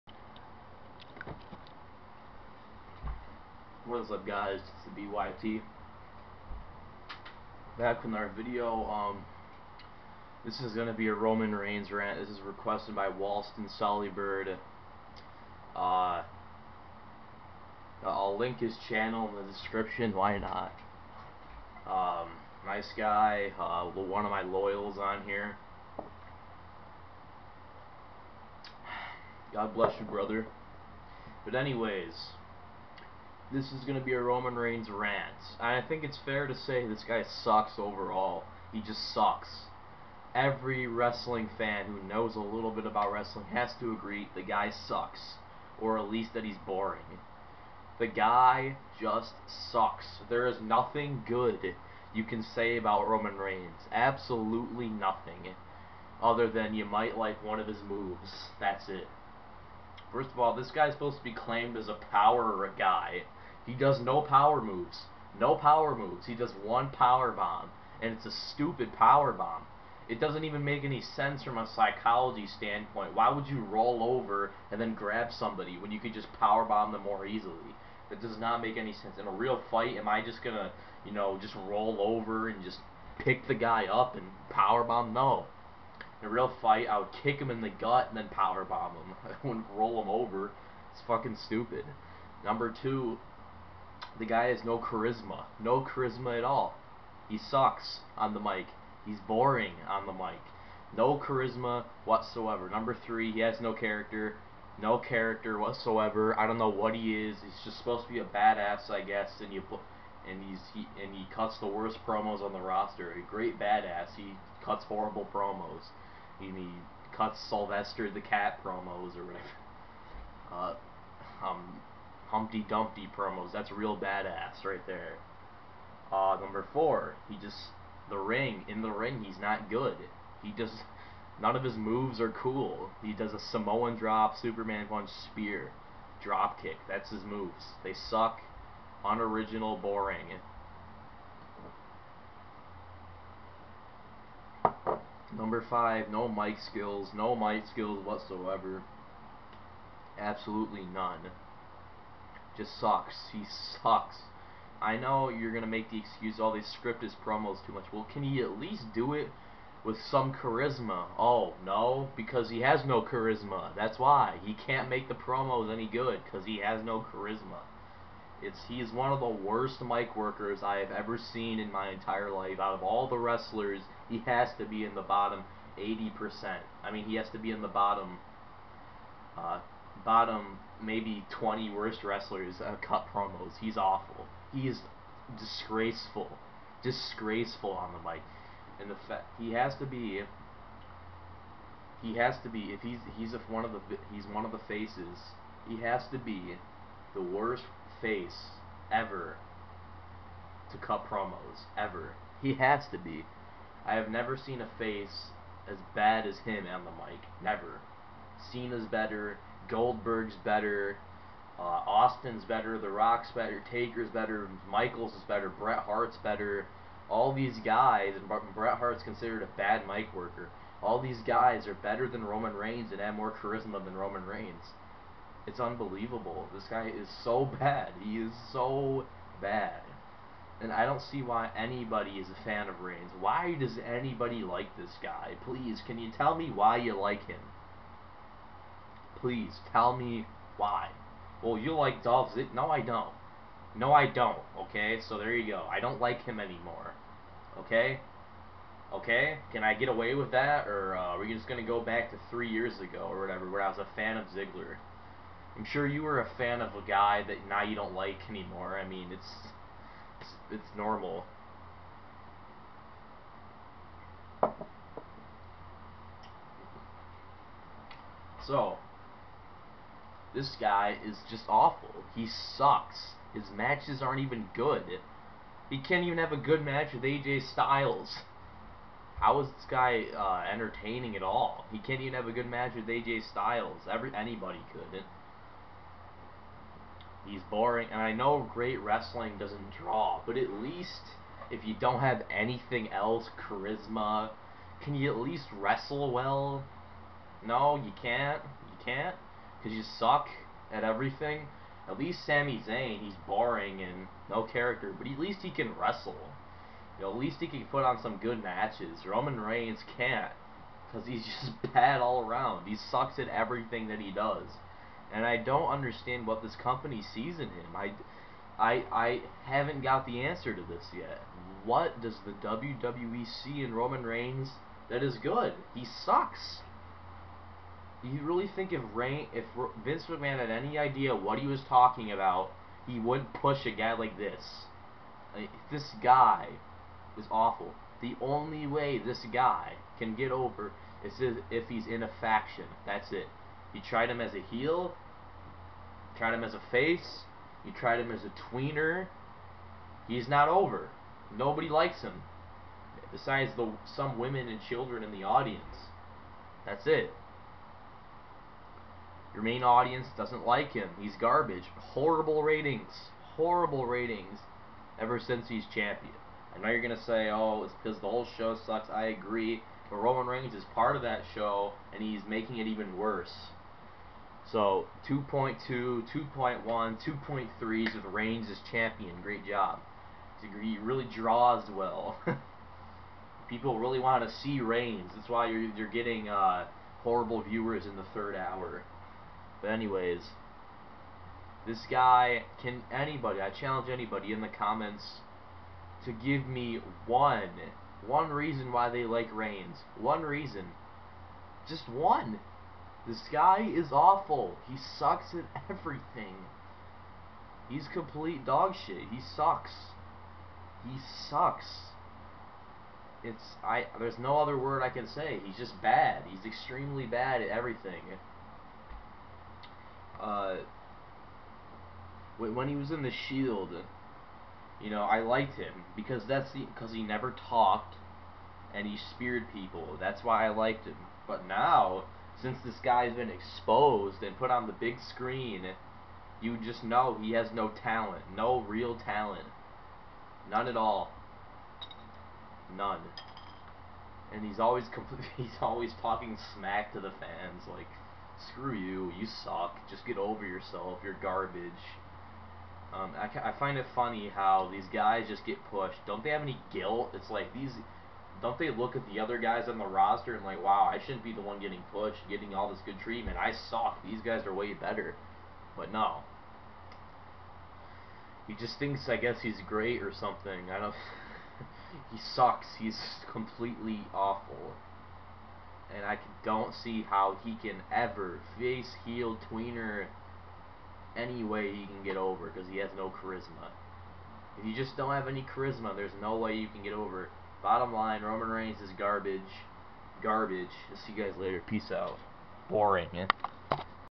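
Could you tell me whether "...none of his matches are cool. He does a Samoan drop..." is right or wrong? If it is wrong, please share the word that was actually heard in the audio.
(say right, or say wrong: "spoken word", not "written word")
wrong: "moves", not "matches".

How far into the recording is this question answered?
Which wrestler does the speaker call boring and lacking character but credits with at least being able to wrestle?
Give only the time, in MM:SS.
05:02.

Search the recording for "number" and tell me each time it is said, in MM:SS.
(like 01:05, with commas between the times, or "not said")
01:32, 01:42, 02:06, 02:25.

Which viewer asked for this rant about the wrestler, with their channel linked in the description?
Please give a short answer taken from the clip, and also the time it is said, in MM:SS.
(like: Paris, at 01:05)
Walston Sollybird, at 00:13.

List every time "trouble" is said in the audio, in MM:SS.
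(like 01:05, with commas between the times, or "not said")
not said.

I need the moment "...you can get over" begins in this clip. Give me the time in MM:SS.
08:06.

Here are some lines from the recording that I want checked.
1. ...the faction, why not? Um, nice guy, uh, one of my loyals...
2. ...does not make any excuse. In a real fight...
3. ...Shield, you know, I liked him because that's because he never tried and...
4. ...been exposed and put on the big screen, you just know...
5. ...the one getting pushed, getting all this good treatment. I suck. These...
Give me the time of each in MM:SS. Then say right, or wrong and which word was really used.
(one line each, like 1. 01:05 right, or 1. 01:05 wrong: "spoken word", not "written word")
1. 00:19 wrong: "description", not "faction"
2. 01:18 wrong: "sense", not "excuse"
3. 07:03 wrong: "talked", not "tried"
4. 07:13 right
5. 07:41 right.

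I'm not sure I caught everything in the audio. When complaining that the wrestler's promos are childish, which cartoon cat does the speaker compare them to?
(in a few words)
Sylvester the Cat.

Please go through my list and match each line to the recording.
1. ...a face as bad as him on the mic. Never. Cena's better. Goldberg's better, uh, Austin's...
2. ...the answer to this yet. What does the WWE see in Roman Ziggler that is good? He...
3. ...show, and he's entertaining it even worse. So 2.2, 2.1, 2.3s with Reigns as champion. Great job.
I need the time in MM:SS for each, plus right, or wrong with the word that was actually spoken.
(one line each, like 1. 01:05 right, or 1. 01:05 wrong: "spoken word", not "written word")
1. 03:24 right
2. 05:20 wrong: "Reigns", not "Ziggler"
3. 06:11 wrong: "making", not "entertaining".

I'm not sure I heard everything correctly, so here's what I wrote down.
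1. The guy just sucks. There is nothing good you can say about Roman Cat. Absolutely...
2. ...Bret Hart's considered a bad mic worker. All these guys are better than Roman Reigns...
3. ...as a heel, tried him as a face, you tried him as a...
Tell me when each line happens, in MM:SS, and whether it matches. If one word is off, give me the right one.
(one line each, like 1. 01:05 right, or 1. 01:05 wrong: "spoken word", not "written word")
1. 00:47 wrong: "Reigns", not "Cat"
2. 03:38 right
3. 05:44 right.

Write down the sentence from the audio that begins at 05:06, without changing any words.
You know, at least he can put on some good matches.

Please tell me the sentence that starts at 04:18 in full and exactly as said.
I mean, it's, it's, it's normal.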